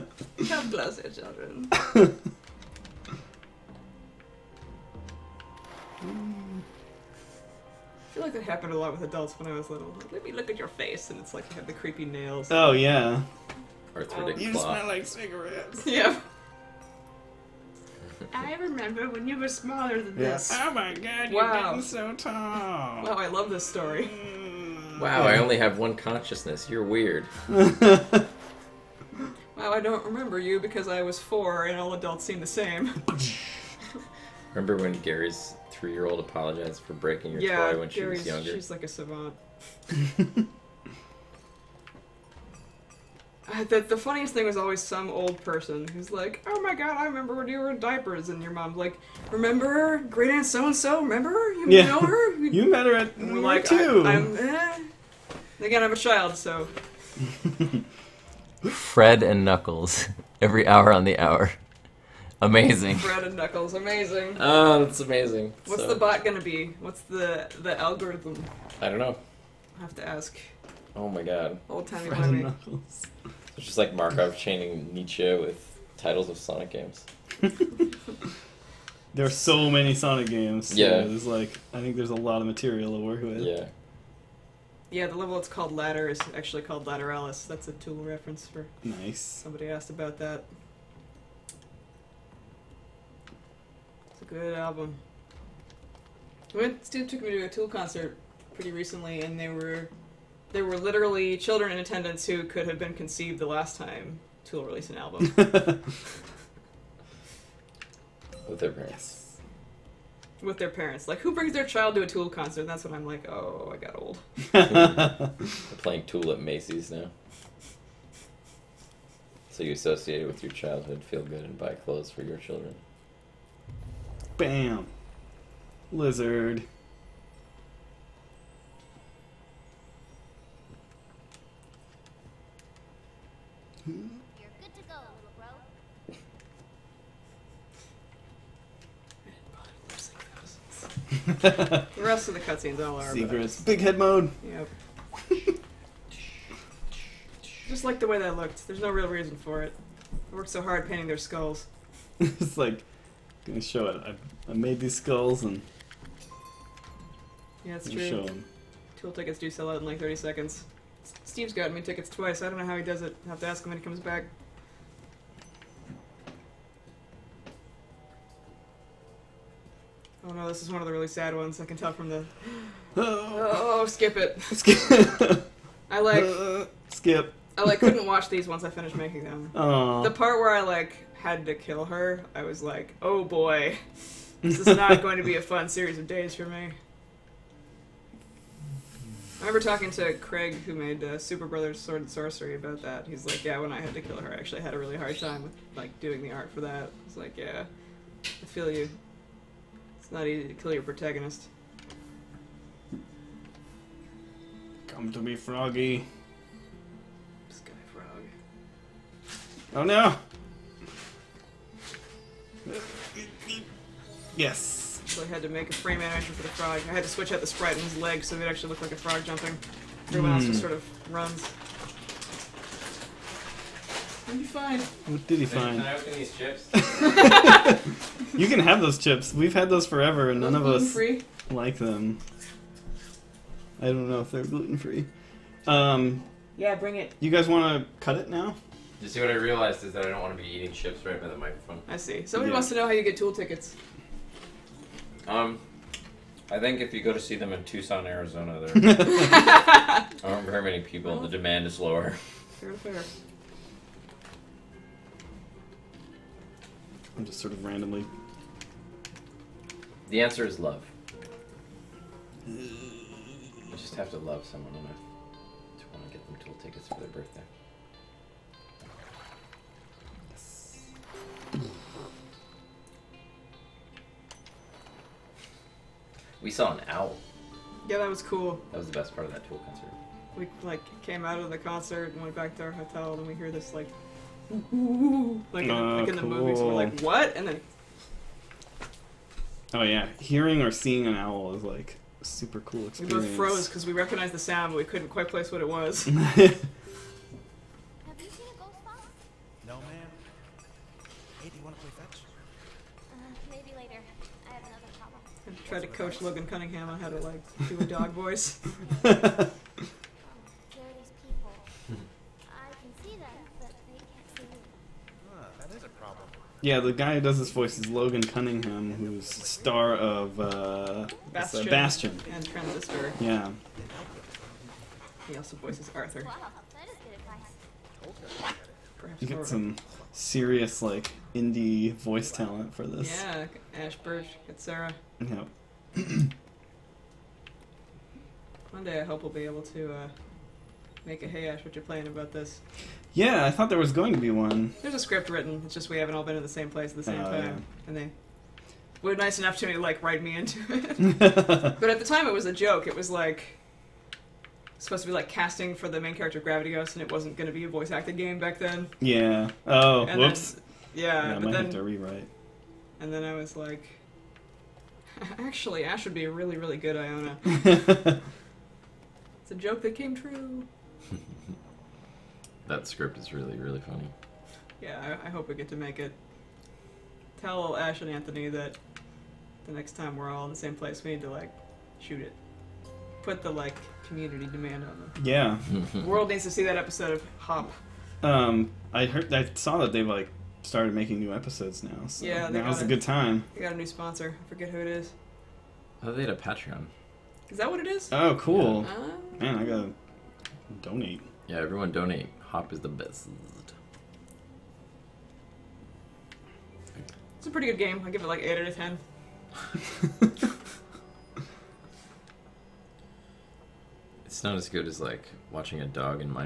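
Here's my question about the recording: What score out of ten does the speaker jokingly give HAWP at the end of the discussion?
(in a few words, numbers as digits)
8.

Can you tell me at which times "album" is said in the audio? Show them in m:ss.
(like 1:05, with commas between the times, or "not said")
1:34, 1:44.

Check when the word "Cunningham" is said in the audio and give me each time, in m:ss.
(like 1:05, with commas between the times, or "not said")
5:06, 5:18.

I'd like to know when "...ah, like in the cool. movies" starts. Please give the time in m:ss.
4:45.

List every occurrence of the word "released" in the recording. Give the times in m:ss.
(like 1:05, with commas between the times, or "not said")
1:44.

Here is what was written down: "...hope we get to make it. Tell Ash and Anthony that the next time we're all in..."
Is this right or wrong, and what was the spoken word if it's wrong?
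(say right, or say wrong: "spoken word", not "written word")
right.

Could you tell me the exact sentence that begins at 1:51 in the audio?
Like, who brings their child to a Tool concert?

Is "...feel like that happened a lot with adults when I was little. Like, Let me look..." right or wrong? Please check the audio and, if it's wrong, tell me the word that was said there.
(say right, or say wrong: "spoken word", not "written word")
right.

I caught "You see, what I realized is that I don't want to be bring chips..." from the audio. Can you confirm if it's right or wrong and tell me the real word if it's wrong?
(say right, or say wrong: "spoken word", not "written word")
wrong: "eating", not "bring".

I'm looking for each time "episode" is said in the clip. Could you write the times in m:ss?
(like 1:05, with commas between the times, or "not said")
6:26, 6:31.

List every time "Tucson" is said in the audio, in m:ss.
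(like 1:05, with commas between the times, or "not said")
4:07.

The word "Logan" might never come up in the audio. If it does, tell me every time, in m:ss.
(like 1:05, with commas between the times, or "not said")
5:06, 5:17.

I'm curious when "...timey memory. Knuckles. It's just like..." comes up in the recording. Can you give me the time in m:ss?
1:11.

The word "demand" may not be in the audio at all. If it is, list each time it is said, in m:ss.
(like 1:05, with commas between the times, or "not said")
4:11, 6:24.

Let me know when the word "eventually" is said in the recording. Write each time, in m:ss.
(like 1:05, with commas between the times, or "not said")
not said.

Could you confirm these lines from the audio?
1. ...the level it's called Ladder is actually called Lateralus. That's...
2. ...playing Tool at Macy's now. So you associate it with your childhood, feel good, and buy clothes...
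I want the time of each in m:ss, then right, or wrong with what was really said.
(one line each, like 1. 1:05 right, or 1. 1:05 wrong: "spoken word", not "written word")
1. 1:25 right
2. 1:55 right.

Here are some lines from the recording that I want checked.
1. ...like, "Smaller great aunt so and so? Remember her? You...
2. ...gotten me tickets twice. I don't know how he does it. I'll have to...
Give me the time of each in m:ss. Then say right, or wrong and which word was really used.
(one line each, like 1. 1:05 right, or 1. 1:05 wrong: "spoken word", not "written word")
1. 0:48 wrong: "Remember", not "Smaller"
2. 2:41 right.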